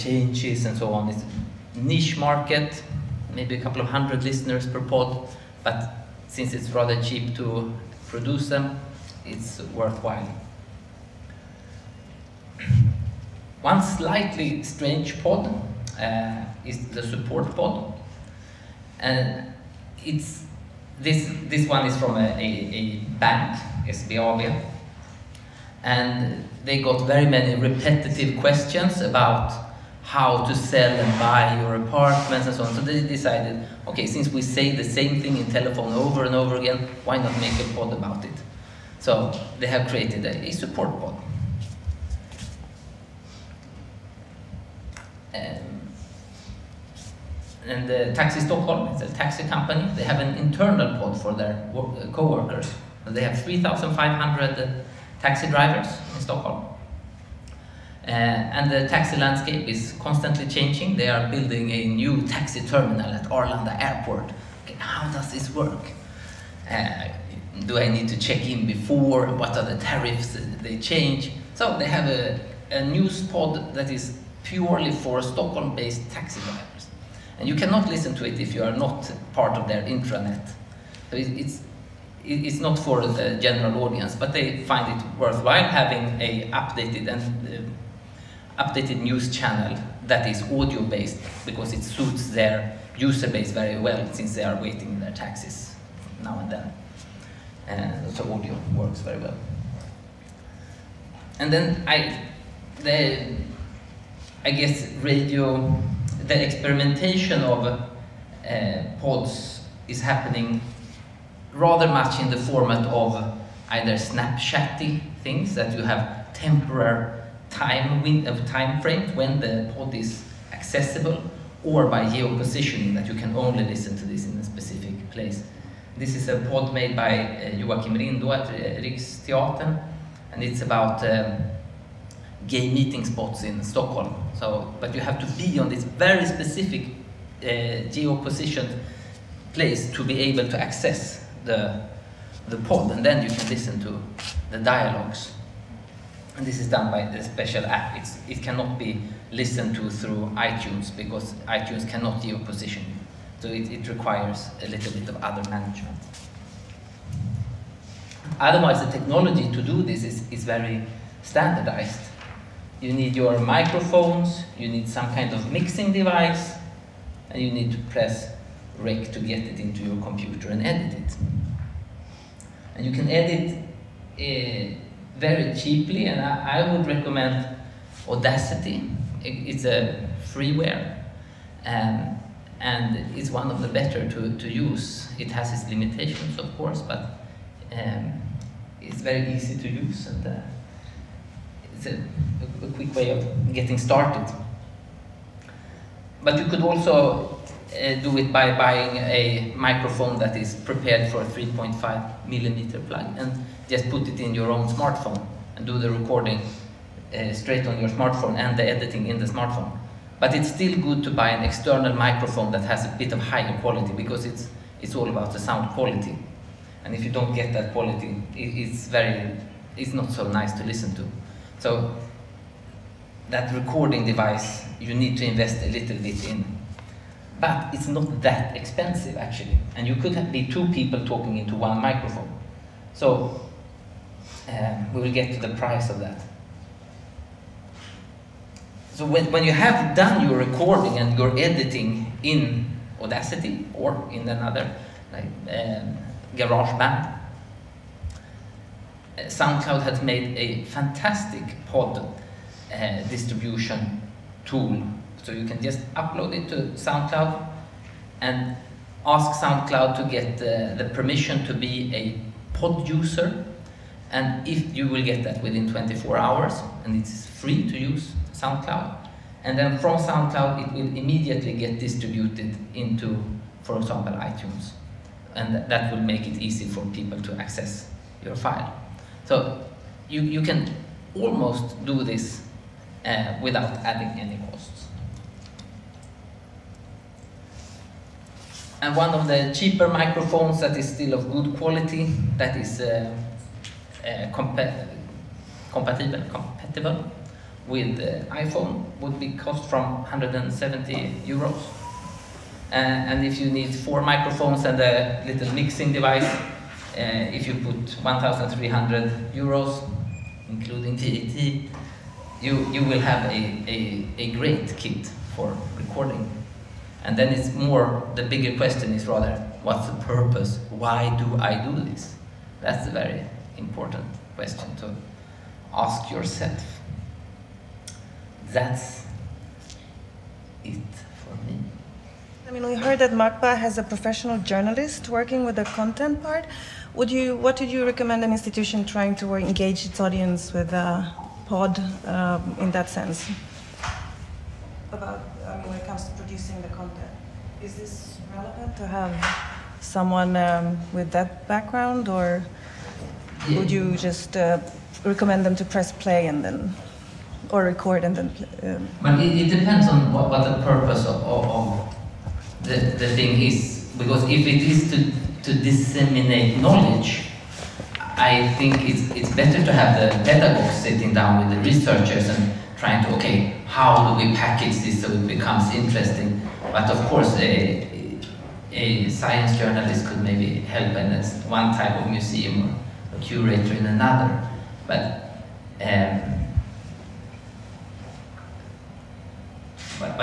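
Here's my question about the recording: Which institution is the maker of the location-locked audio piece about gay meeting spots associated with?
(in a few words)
Riksteatern.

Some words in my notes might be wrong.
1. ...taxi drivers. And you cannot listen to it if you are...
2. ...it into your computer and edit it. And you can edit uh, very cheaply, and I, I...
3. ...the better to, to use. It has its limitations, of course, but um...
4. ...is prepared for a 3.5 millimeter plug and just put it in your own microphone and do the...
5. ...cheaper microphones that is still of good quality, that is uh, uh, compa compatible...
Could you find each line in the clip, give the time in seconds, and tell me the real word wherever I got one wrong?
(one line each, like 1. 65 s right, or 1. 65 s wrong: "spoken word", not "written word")
1. 76 s right
2. 169 s right
3. 183 s right
4. 200 s wrong: "smartphone", not "microphone"
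5. 289 s right.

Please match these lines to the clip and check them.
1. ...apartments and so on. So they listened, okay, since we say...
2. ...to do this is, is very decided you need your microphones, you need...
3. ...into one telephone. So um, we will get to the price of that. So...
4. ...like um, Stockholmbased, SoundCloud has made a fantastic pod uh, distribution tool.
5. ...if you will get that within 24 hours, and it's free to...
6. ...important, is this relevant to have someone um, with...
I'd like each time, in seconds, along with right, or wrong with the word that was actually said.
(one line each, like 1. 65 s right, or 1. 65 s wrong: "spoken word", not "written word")
1. 31 s wrong: "decided", not "listened"
2. 159 s wrong: "standardized", not "decided"
3. 231 s wrong: "microphone", not "telephone"
4. 245 s wrong: "GarageBand", not "Stockholmbased"
5. 264 s right
6. 346 s wrong: "content", not "important".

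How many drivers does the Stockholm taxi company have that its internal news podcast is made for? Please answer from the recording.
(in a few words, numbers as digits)
3,500.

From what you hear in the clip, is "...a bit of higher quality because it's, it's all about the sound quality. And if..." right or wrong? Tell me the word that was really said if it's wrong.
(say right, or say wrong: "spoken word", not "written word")
right.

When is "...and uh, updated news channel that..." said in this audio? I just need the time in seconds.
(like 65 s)
87 s.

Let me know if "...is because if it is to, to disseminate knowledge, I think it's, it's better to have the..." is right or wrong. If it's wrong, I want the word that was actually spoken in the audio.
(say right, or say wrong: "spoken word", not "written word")
right.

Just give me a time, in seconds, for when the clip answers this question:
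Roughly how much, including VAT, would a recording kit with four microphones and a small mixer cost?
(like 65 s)
308 s.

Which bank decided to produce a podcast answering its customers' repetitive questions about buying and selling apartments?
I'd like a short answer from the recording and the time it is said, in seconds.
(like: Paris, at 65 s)
SBAB, at 23 s.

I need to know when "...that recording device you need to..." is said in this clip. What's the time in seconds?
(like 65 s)
223 s.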